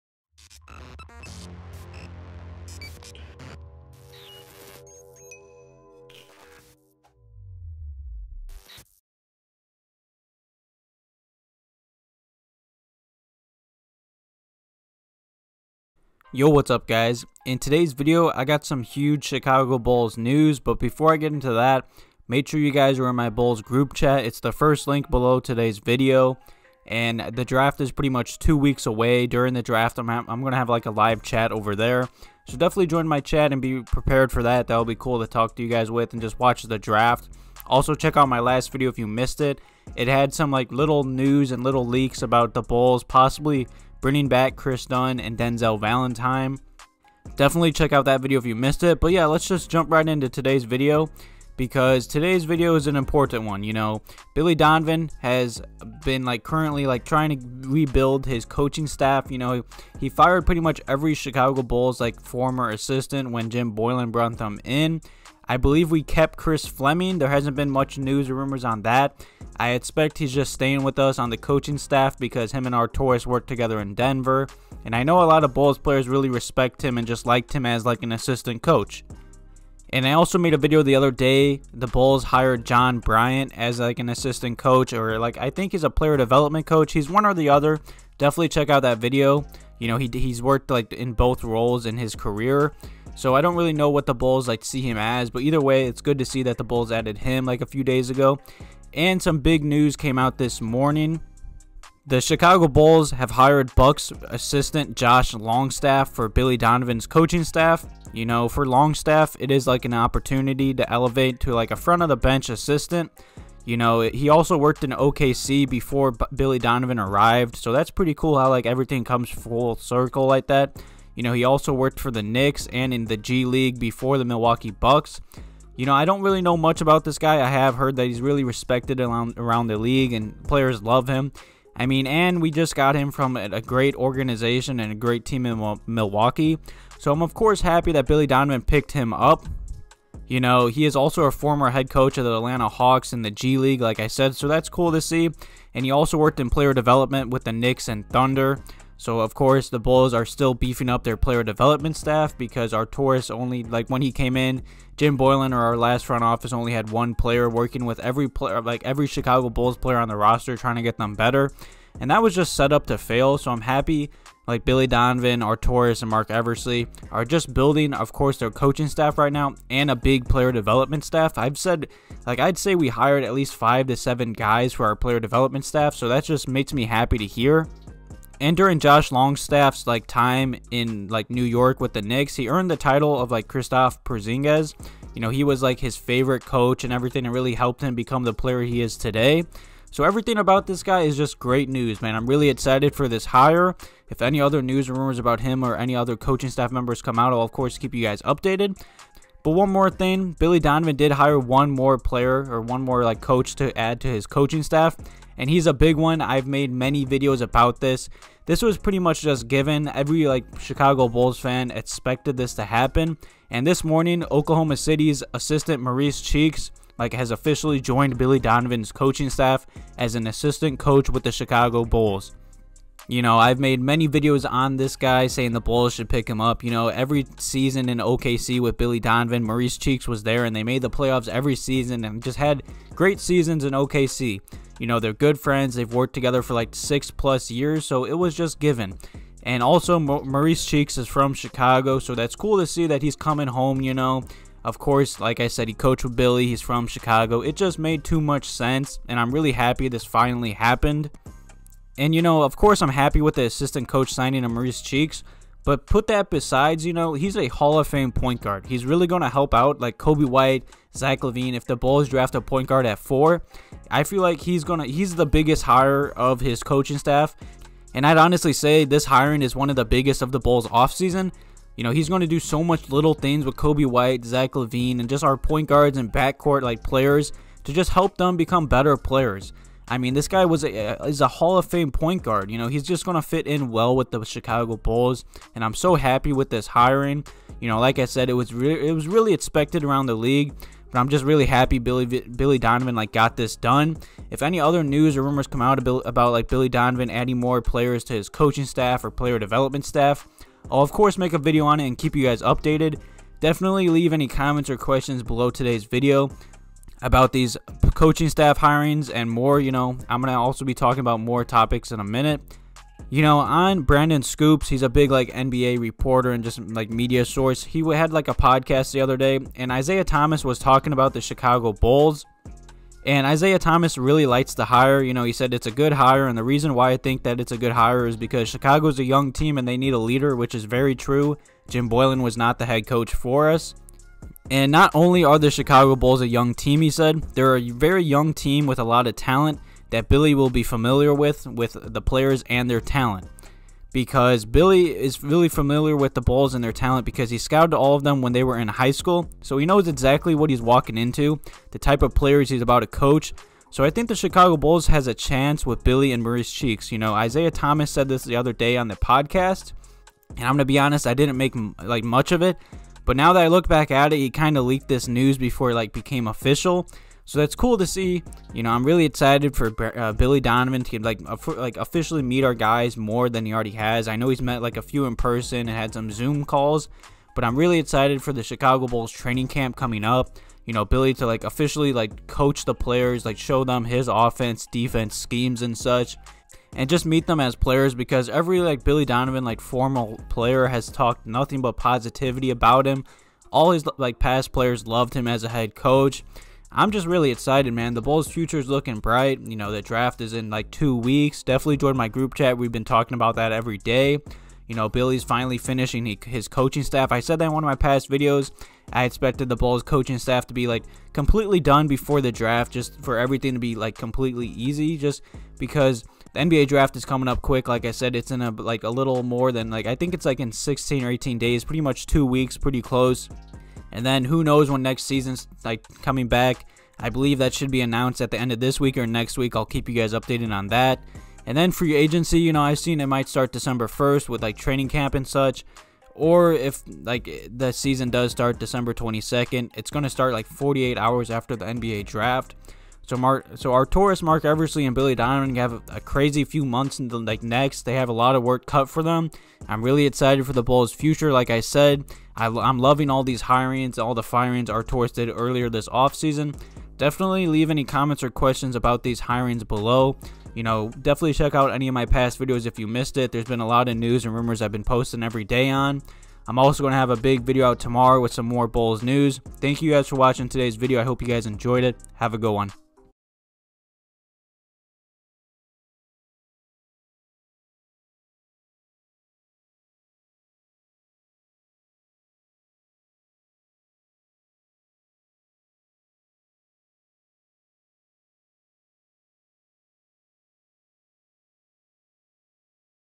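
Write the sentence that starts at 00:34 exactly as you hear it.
That'll be cool to talk to you guys with and just watch the draft.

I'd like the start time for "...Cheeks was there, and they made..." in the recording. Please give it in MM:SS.
03:49.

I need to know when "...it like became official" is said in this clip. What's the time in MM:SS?
06:05.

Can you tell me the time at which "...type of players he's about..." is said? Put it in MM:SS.
05:51.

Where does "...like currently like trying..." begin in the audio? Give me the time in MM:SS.
00:56.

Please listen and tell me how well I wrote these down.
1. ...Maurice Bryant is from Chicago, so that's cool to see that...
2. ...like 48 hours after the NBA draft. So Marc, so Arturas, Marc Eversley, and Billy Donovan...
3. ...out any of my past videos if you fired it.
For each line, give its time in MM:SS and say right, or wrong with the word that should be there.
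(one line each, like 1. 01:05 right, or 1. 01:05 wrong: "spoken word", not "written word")
1. 03:59 wrong: "Cheeks", not "Bryant"
2. 07:20 right
3. 07:41 wrong: "missed", not "fired".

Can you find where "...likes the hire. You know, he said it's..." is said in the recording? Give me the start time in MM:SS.
05:24.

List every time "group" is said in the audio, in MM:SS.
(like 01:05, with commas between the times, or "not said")
00:23, 06:42.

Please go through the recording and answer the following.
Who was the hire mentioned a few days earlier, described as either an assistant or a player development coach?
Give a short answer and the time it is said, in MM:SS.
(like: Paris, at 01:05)
John Bryant, at 01:22.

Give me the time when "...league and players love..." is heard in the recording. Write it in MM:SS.
02:09.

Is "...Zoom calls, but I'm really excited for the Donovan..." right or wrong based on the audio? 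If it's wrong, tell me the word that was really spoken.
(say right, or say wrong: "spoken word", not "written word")
wrong: "Chicago", not "Donovan".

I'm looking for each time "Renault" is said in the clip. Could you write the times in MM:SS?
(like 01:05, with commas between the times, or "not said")
not said.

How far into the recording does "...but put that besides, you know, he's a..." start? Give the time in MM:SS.
04:15.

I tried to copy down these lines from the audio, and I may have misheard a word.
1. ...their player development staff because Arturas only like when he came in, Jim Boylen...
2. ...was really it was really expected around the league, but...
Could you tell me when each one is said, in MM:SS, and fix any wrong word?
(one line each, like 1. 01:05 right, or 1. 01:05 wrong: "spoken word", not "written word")
1. 02:31 right
2. 04:48 right.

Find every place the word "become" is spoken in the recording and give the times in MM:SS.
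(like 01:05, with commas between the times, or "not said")
03:07, 04:38.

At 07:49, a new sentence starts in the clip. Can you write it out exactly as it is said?
Thank you guys for watching today's video.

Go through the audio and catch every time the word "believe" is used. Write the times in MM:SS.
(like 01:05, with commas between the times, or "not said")
01:05, 07:07.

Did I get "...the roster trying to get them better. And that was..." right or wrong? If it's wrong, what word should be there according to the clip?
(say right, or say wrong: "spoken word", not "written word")
right.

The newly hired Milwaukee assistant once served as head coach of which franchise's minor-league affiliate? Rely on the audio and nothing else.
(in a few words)
Atlanta Hawks.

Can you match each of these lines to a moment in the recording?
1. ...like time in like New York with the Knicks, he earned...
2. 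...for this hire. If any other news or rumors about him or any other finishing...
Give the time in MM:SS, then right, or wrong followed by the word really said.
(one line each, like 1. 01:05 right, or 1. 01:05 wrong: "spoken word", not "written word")
1. 02:59 right
2. 03:12 wrong: "coaching", not "finishing".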